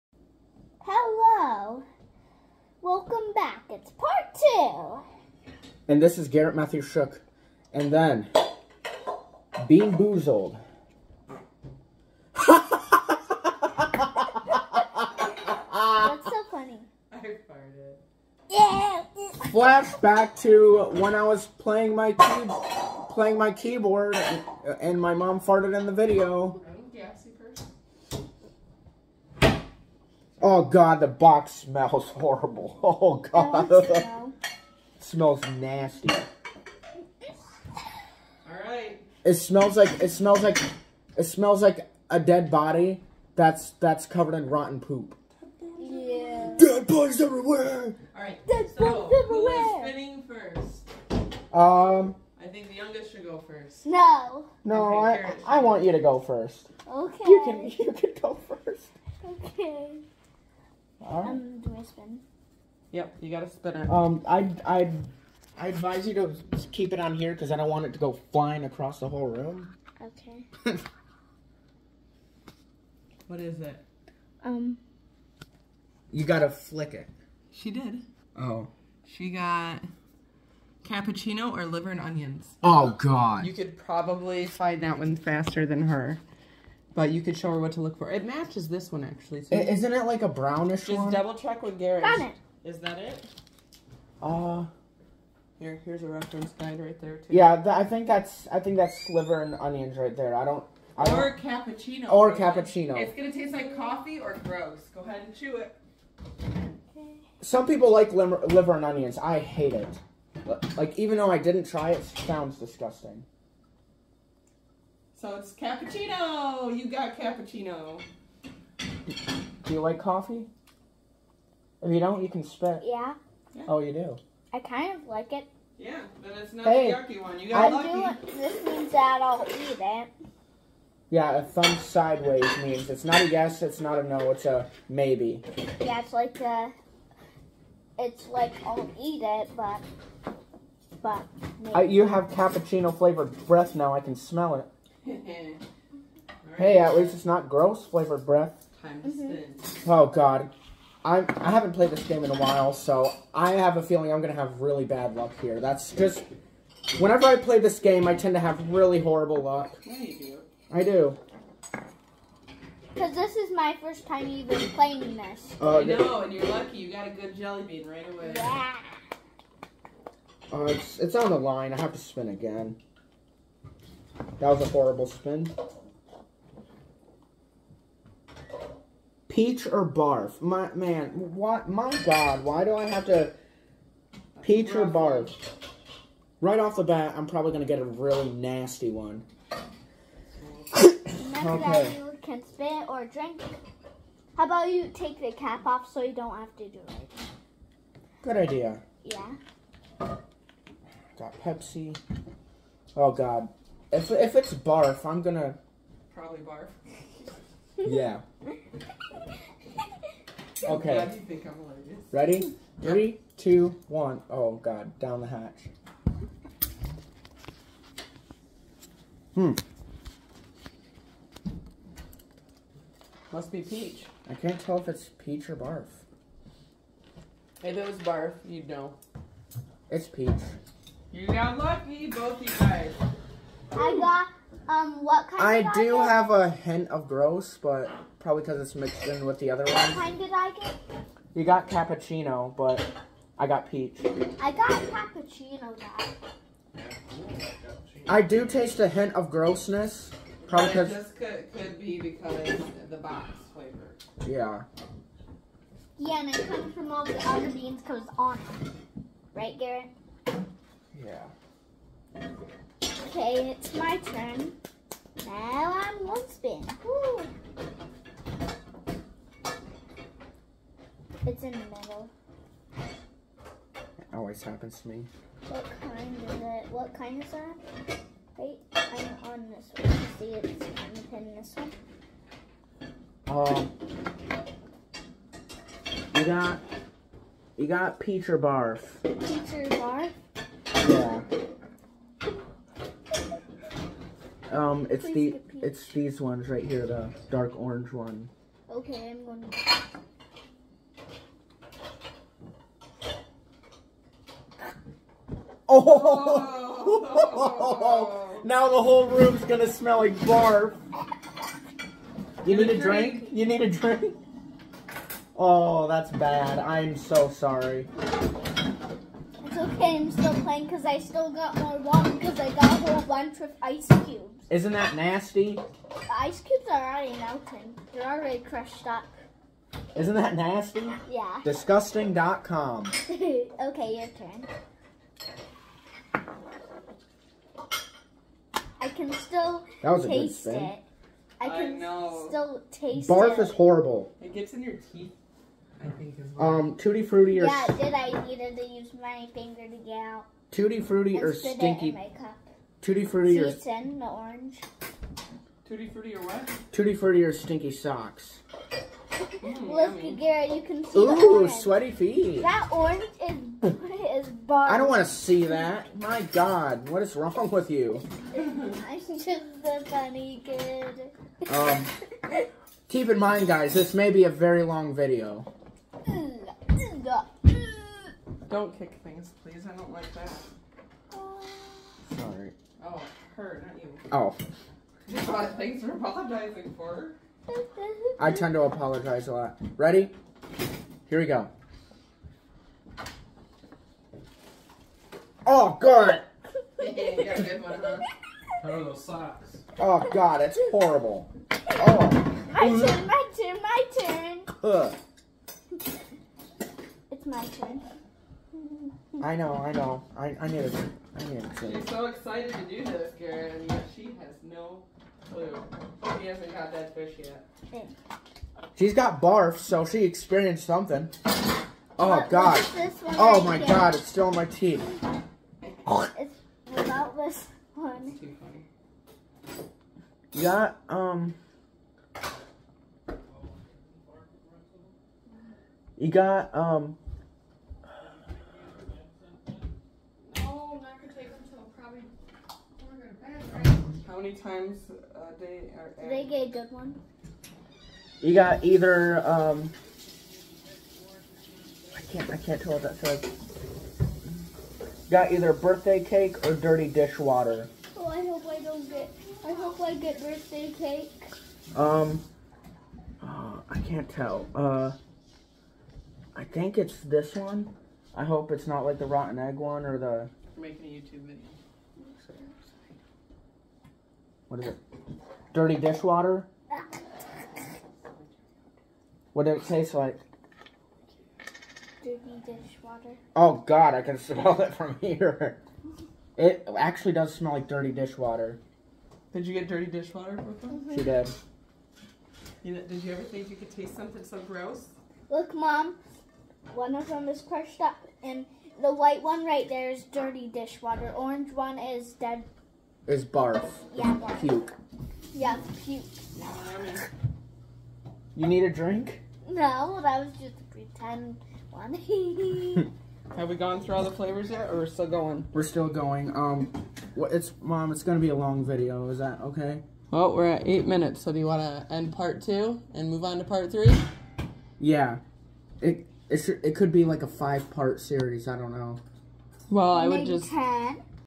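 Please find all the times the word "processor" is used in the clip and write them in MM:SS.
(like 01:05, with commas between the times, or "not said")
not said.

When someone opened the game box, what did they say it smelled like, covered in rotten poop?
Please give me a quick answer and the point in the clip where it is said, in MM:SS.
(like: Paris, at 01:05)
a dead body, at 00:42.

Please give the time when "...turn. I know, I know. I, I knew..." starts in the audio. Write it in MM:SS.
06:47.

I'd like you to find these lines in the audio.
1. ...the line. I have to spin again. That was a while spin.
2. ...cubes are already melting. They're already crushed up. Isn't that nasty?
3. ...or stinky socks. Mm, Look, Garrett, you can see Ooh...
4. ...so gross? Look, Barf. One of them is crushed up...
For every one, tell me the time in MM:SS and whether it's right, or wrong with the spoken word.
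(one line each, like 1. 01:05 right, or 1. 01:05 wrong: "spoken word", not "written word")
1. 02:51 wrong: "horrible", not "while"
2. 05:26 right
3. 05:57 right
4. 08:14 wrong: "Mom", not "Barf".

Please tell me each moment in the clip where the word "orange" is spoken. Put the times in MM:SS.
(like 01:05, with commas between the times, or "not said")
04:57, 05:54, 06:02, 08:21.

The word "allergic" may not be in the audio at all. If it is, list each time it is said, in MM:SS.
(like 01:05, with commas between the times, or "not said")
03:31.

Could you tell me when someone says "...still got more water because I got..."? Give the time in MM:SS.
05:20.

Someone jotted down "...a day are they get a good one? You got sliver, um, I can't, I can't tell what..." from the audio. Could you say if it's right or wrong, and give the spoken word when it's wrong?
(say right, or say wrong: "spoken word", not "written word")
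wrong: "either", not "sliver".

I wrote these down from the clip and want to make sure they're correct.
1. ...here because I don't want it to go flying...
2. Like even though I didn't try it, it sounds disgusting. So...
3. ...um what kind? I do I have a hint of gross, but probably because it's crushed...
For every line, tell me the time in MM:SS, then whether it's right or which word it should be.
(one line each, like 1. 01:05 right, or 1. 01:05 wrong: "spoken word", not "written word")
1. 01:07 right
2. 01:50 right
3. 03:54 wrong: "mixed", not "crushed".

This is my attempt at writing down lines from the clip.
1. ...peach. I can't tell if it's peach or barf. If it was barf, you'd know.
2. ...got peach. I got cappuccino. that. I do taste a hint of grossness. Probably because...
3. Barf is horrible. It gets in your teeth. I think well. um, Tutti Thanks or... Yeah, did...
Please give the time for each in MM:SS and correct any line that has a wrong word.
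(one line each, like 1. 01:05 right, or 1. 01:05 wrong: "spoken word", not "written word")
1. 03:43 right
2. 04:03 right
3. 05:43 wrong: "Frutti", not "Thanks".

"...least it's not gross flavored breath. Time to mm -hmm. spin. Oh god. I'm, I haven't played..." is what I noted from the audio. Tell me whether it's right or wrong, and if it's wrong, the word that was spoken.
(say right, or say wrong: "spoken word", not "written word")
right.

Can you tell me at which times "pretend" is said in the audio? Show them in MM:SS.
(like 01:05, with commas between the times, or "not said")
08:30.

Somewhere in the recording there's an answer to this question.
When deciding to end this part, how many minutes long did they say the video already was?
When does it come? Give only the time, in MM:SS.
08:40.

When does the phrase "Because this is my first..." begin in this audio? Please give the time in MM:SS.
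02:42.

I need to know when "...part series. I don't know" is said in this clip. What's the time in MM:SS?
08:47.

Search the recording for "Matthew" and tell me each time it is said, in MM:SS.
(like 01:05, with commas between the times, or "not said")
00:06.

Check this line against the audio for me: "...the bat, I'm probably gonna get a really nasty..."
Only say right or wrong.
right.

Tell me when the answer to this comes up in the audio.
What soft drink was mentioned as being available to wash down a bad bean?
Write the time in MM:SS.
03:21.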